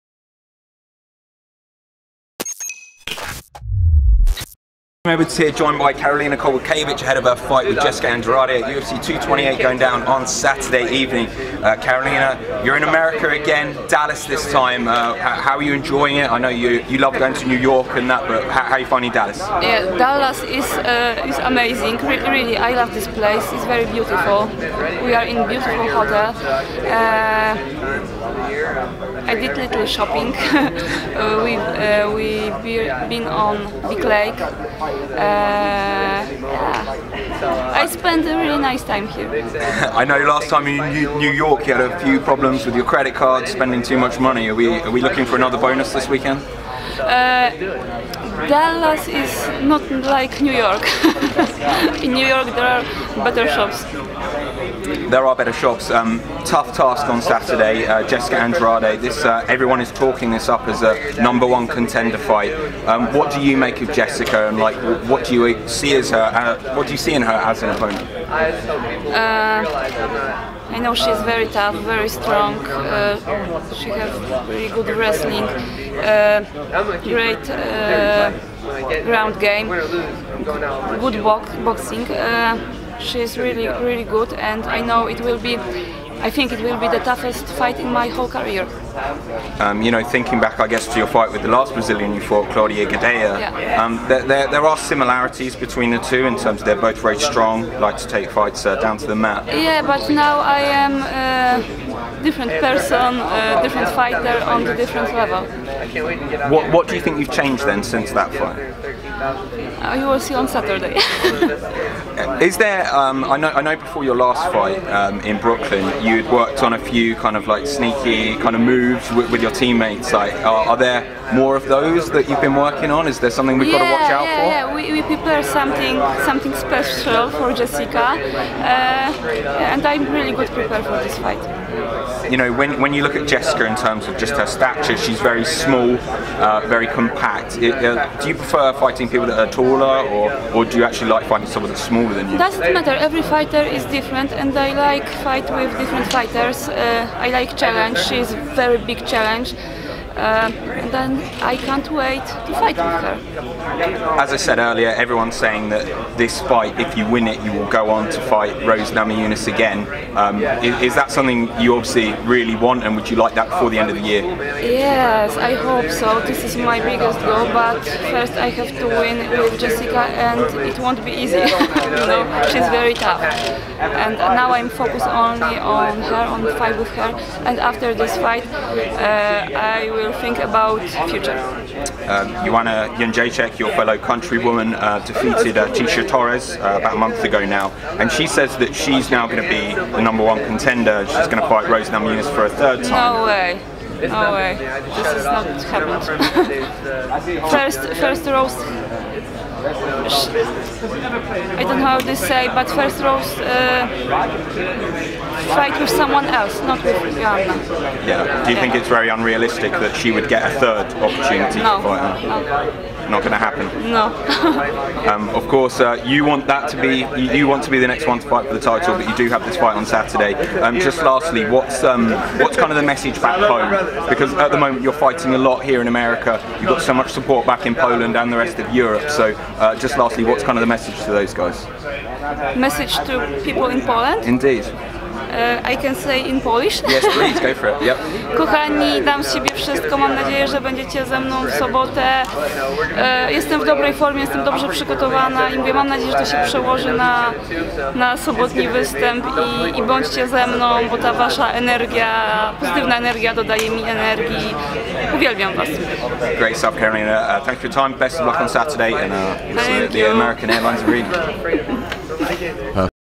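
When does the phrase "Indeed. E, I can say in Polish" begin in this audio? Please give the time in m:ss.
3:54.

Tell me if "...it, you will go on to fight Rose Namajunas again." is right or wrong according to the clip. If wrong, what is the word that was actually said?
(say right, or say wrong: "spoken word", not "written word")
right.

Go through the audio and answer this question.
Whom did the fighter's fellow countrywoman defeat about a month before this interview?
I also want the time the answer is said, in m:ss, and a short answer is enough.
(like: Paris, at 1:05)
Tecia Torres, at 3:05.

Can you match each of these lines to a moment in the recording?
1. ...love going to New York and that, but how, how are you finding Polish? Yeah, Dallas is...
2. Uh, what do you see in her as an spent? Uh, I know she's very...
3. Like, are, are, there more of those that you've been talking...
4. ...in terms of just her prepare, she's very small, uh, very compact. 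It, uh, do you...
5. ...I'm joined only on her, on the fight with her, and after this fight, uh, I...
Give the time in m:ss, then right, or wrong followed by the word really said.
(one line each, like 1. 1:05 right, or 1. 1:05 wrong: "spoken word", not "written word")
1. 0:16 wrong: "Dallas", not "Polish"
2. 1:06 wrong: "opponent", not "spent"
3. 2:00 wrong: "working", not "talking"
4. 2:13 wrong: "stature", not "prepare"
5. 2:54 wrong: "focused", not "joined".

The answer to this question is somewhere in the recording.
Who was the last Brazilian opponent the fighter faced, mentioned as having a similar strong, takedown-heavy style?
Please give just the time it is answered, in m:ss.
1:32.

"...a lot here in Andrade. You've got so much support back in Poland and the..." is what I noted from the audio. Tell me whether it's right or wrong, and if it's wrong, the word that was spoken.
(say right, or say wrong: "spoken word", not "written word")
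wrong: "America", not "Andrade".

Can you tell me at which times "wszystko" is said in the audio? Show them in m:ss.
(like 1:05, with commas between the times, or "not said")
3:59.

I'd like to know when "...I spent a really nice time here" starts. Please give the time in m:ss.
0:37.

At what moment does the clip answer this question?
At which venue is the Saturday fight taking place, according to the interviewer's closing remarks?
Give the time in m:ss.
4:20.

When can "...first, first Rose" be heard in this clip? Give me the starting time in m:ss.
3:17.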